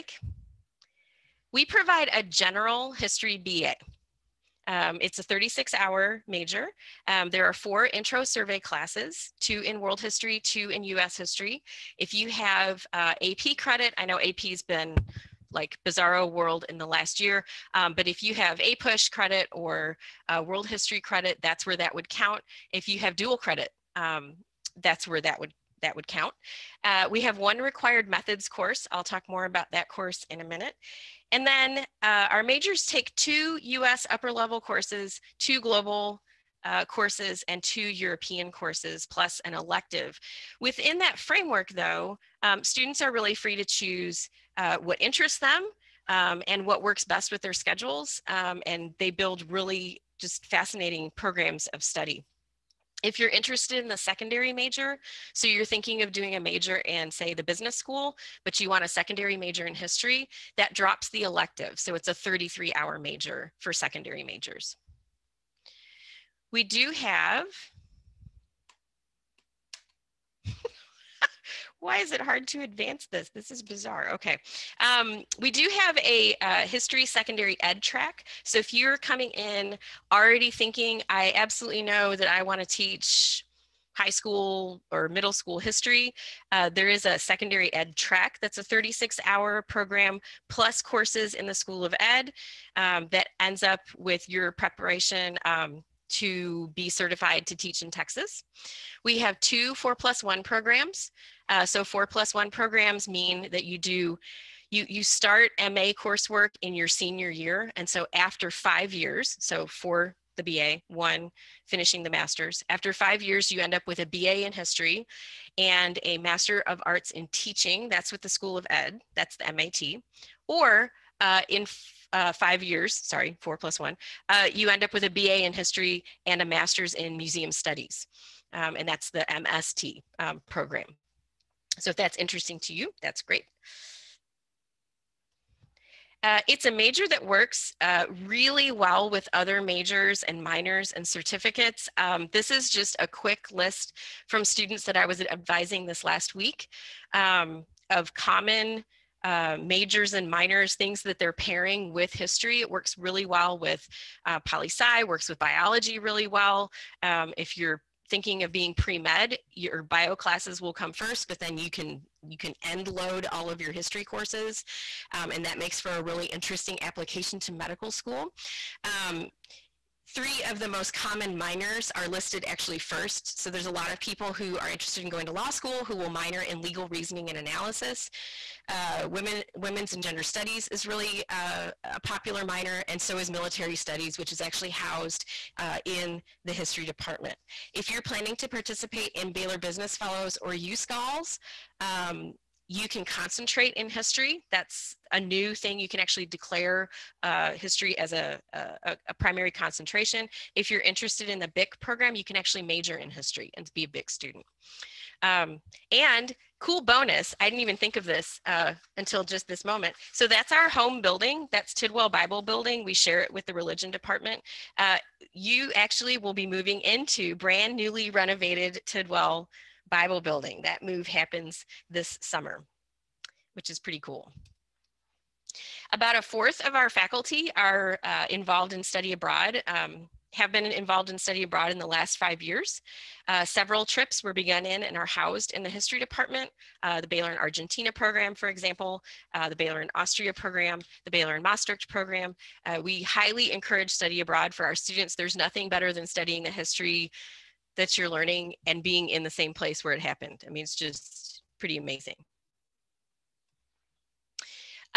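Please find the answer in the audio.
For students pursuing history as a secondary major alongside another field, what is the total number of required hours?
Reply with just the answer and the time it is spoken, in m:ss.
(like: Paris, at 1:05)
33, at 1:02.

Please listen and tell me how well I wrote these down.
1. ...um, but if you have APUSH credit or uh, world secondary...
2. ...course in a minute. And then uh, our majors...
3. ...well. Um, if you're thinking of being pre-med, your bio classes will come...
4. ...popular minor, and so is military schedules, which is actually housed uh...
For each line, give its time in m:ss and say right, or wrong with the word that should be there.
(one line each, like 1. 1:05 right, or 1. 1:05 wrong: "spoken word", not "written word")
1. 0:17 wrong: "history", not "secondary"
2. 0:29 right
3. 2:36 right
4. 3:02 wrong: "studies", not "schedules".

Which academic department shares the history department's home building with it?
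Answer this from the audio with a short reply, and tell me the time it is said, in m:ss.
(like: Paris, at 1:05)
religion, at 3:33.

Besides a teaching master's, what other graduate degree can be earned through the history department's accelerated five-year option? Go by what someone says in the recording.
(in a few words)
museum studies.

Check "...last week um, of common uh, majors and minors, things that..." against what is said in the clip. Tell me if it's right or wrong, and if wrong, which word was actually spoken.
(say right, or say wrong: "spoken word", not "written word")
right.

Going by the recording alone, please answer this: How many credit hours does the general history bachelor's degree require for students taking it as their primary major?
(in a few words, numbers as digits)
36.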